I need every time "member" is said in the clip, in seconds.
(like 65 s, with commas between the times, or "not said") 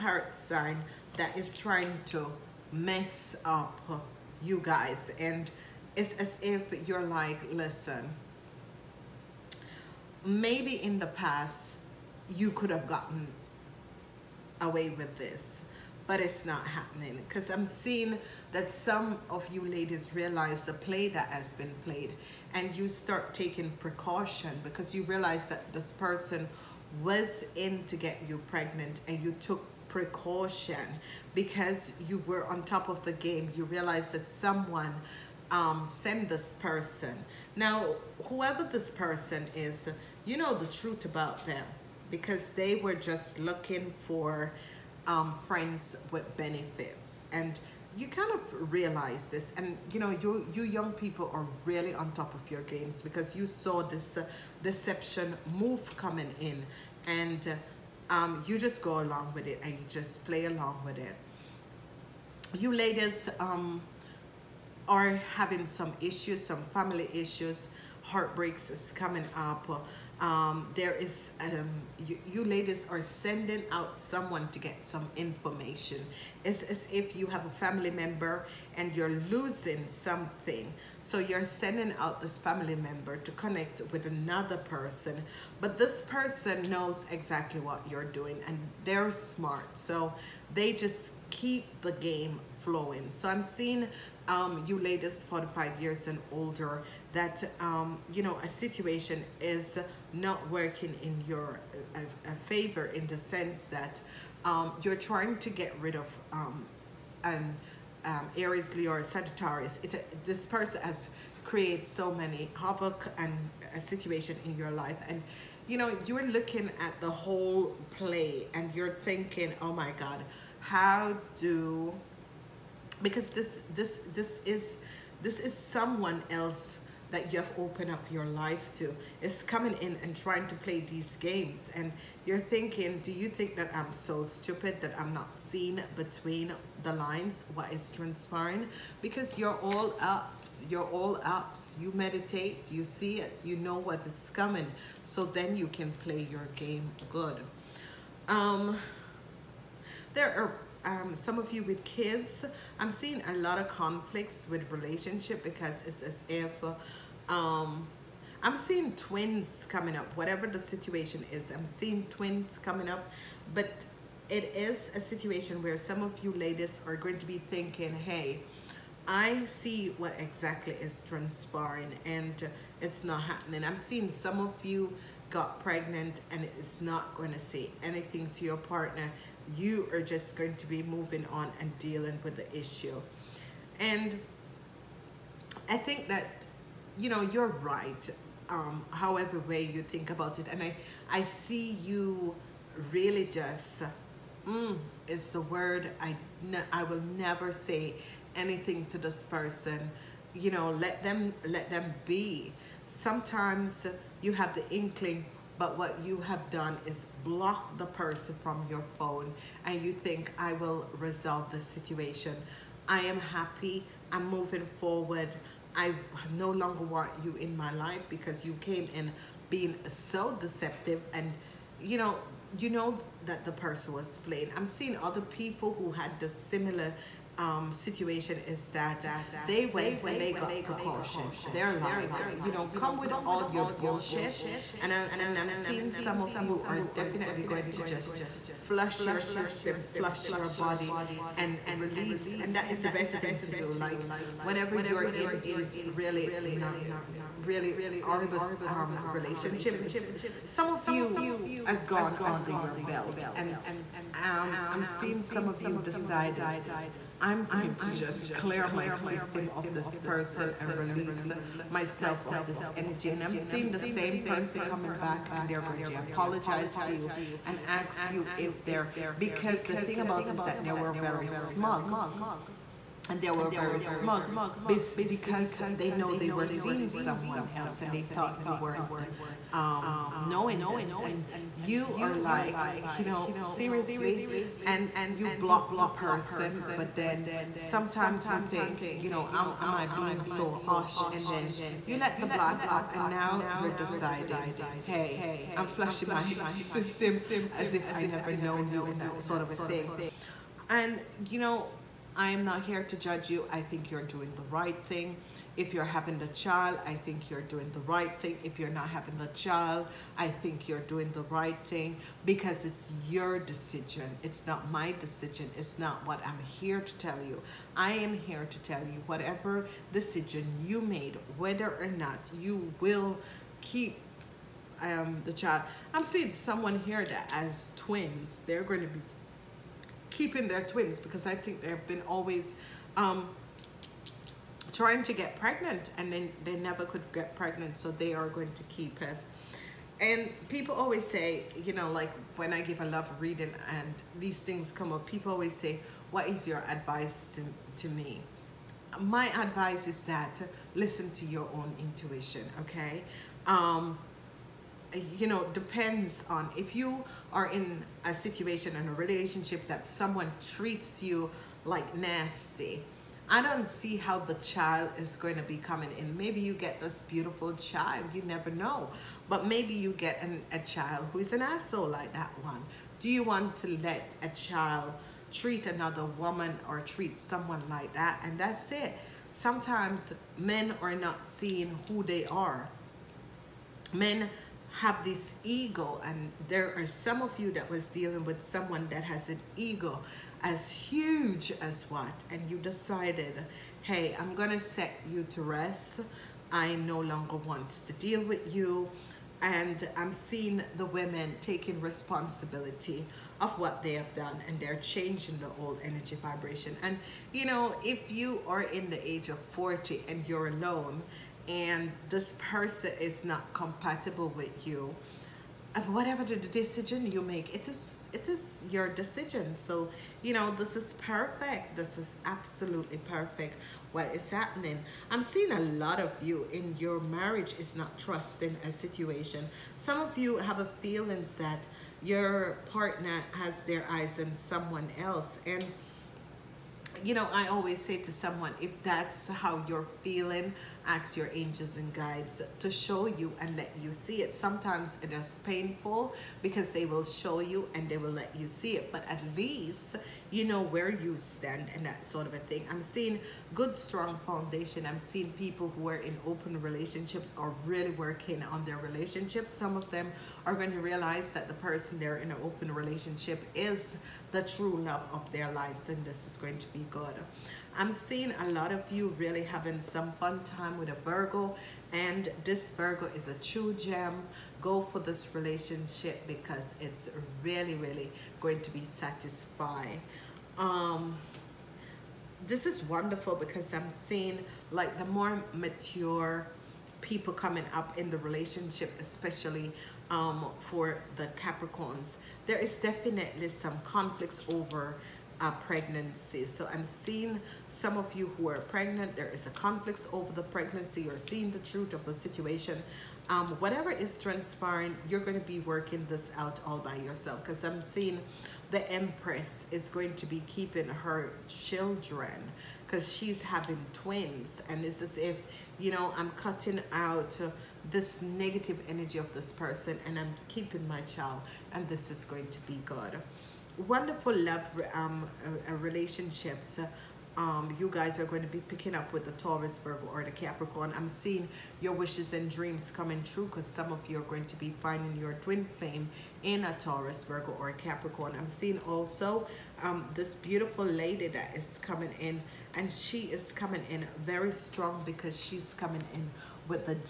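77 s, 82 s.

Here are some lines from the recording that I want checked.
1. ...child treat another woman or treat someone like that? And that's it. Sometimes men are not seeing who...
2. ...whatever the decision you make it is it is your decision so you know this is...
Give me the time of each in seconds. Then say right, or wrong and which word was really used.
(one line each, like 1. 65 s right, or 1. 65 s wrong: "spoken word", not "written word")
1. 374 s right
2. 415 s right.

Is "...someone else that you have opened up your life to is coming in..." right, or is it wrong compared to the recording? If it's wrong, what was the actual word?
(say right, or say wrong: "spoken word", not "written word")
right.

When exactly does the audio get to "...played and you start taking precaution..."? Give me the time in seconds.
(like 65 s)
21 s.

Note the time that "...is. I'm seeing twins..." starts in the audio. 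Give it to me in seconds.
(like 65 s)
161 s.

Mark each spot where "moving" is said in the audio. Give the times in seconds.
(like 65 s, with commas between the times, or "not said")
180 s, 214 s.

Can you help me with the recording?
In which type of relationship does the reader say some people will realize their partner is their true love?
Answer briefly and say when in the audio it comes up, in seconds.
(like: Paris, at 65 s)
open relationship, at 462 s.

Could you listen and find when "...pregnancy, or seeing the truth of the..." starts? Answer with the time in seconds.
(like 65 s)
500 s.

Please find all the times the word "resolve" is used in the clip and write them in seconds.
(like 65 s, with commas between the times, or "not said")
210 s.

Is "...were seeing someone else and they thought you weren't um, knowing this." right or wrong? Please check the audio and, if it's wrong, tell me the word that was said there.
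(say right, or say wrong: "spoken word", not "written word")
right.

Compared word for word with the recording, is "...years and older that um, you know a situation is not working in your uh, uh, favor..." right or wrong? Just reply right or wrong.
right.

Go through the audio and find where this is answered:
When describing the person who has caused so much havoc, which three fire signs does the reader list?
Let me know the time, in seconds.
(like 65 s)
108 s.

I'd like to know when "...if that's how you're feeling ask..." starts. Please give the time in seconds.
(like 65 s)
438 s.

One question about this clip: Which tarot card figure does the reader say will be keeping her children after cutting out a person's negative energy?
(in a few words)
The Empress.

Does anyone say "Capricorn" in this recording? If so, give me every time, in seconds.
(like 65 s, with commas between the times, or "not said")
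491 s, 530 s, 537 s.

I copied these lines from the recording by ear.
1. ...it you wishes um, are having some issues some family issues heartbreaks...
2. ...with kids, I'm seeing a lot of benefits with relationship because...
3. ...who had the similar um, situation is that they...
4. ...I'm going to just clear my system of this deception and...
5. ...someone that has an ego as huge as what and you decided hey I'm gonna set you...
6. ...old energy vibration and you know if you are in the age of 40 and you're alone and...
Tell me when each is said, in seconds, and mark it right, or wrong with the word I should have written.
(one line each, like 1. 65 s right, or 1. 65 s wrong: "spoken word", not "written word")
1. 60 s wrong: "ladies", not "wishes"
2. 151 s wrong: "conflicts", not "benefits"
3. 225 s right
4. 257 s wrong: "person", not "deception"
5. 388 s right
6. 405 s right.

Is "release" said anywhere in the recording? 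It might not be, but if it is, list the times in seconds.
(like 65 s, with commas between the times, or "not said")
241 s, 260 s.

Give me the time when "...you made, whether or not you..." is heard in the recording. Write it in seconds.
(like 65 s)
320 s.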